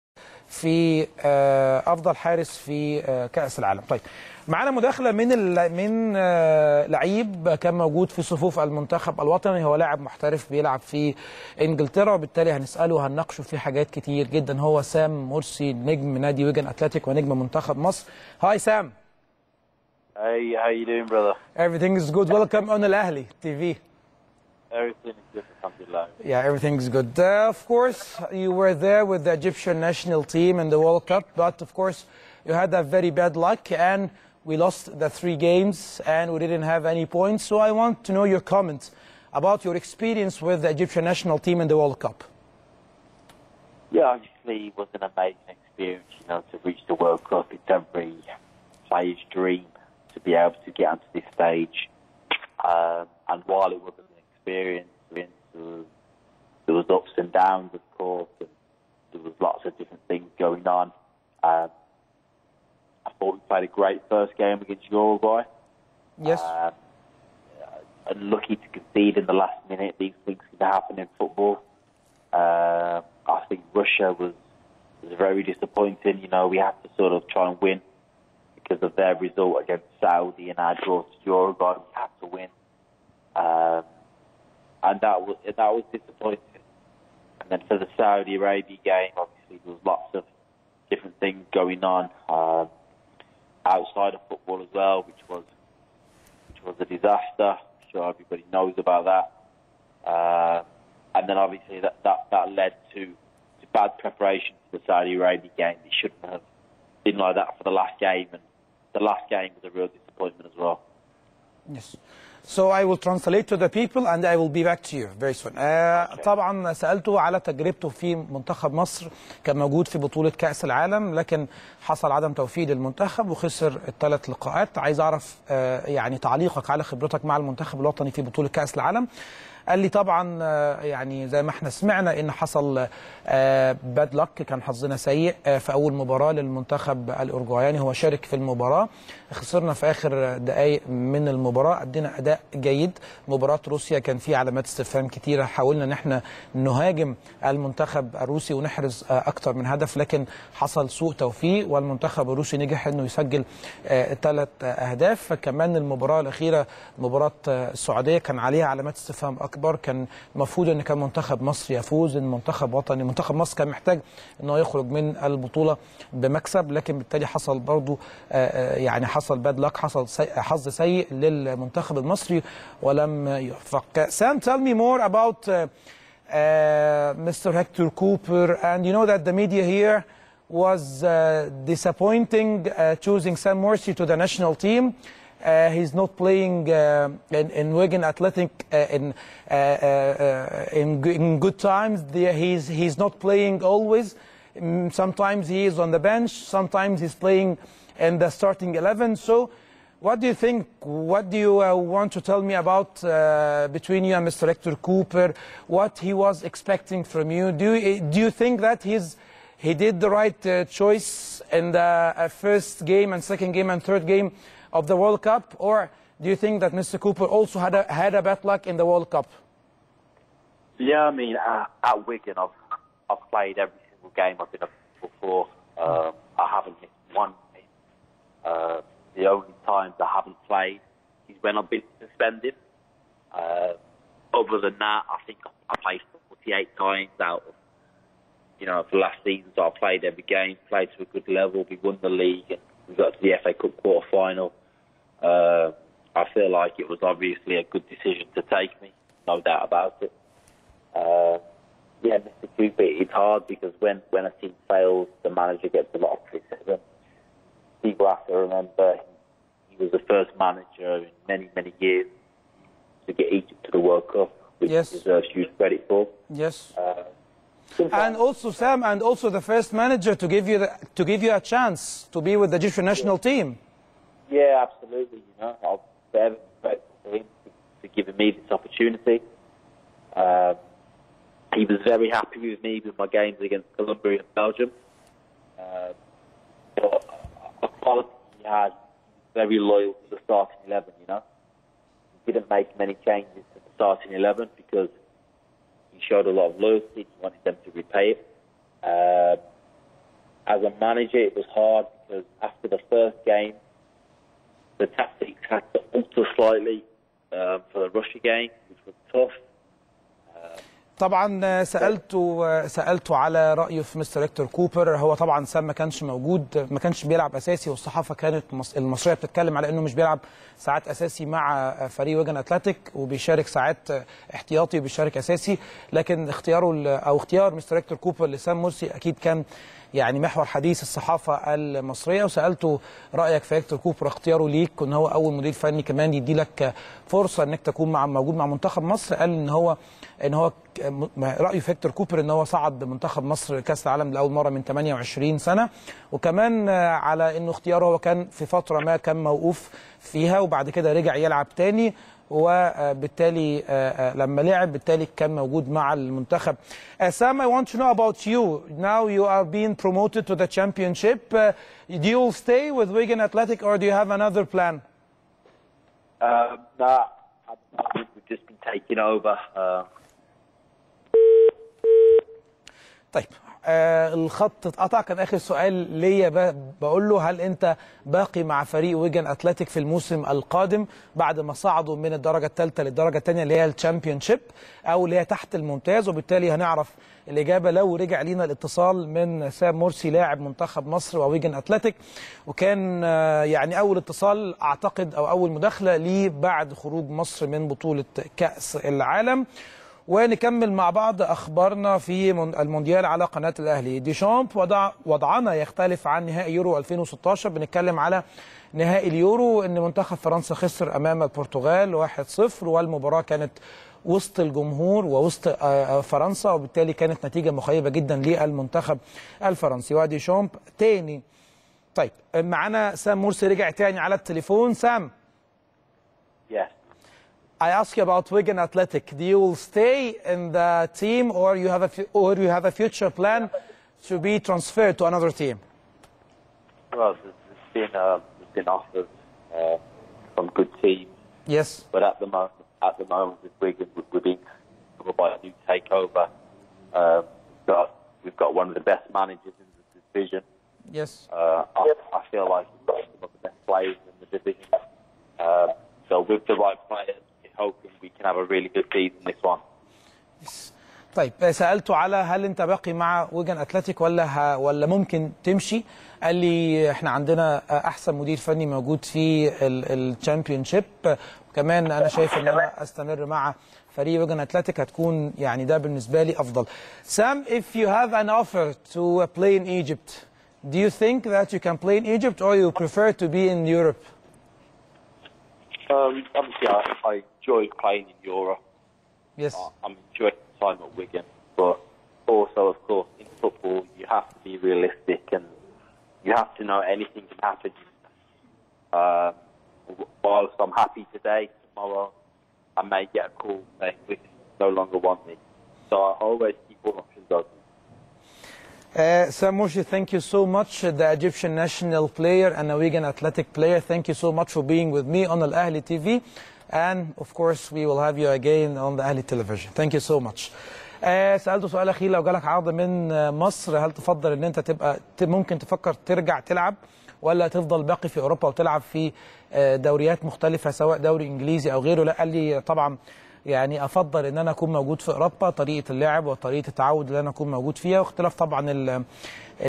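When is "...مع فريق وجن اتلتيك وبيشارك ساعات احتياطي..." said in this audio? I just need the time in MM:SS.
05:21.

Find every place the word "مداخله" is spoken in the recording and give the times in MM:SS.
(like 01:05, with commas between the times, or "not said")
00:04, 06:35.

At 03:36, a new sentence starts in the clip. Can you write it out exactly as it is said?
Cúper also had a, had a bad luck in the World Cup?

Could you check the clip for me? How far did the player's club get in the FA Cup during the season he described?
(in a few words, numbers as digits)
quarter final.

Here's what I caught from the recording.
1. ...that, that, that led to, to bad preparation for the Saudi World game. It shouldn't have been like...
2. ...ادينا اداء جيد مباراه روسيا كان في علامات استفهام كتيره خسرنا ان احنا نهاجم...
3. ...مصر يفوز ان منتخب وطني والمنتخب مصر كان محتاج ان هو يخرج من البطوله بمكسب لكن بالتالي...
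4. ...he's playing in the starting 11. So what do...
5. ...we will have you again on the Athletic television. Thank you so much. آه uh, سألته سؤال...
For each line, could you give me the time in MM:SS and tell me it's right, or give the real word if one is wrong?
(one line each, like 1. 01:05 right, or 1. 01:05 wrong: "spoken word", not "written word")
1. 01:41 wrong: "Arabia", not "World"
2. 02:21 wrong: "حاولنا", not "خسرنا"
3. 02:41 wrong: "منتخب", not "والمنتخب"
4. 03:17 right
5. 08:37 wrong: "Ahli", not "Athletic".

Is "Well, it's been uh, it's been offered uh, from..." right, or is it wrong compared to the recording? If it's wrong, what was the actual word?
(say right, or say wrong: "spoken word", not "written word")
right.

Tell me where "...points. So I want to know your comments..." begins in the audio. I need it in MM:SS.
00:37.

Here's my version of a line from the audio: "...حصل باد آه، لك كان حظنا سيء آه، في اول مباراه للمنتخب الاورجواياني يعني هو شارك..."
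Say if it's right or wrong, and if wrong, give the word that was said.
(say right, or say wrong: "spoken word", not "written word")
right.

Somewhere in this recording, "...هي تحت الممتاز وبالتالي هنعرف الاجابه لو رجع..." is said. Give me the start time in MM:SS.
06:25.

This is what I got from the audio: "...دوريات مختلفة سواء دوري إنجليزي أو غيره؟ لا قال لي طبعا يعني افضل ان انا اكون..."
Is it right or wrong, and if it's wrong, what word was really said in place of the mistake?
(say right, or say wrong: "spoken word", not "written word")
right.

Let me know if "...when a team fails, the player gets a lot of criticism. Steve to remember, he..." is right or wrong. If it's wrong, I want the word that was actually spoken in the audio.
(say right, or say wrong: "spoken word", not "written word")
wrong: "manager", not "player".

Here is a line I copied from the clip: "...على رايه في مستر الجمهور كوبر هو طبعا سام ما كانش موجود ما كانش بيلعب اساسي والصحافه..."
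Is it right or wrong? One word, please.
wrong.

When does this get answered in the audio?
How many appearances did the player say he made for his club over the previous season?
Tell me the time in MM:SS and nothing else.
03:56.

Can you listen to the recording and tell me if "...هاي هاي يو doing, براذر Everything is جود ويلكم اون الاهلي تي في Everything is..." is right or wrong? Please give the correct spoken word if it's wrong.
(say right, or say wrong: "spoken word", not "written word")
right.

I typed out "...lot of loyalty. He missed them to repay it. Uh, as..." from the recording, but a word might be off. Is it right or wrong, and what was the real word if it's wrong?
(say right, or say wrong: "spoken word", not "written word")
wrong: "wanted", not "missed".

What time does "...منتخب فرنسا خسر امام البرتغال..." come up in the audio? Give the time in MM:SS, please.
06:49.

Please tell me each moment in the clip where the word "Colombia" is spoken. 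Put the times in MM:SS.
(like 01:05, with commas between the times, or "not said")
04:43.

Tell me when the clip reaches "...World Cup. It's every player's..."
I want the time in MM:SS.
00:46.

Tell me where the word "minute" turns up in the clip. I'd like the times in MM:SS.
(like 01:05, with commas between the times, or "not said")
01:09.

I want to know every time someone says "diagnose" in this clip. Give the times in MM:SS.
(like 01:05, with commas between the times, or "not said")
not said.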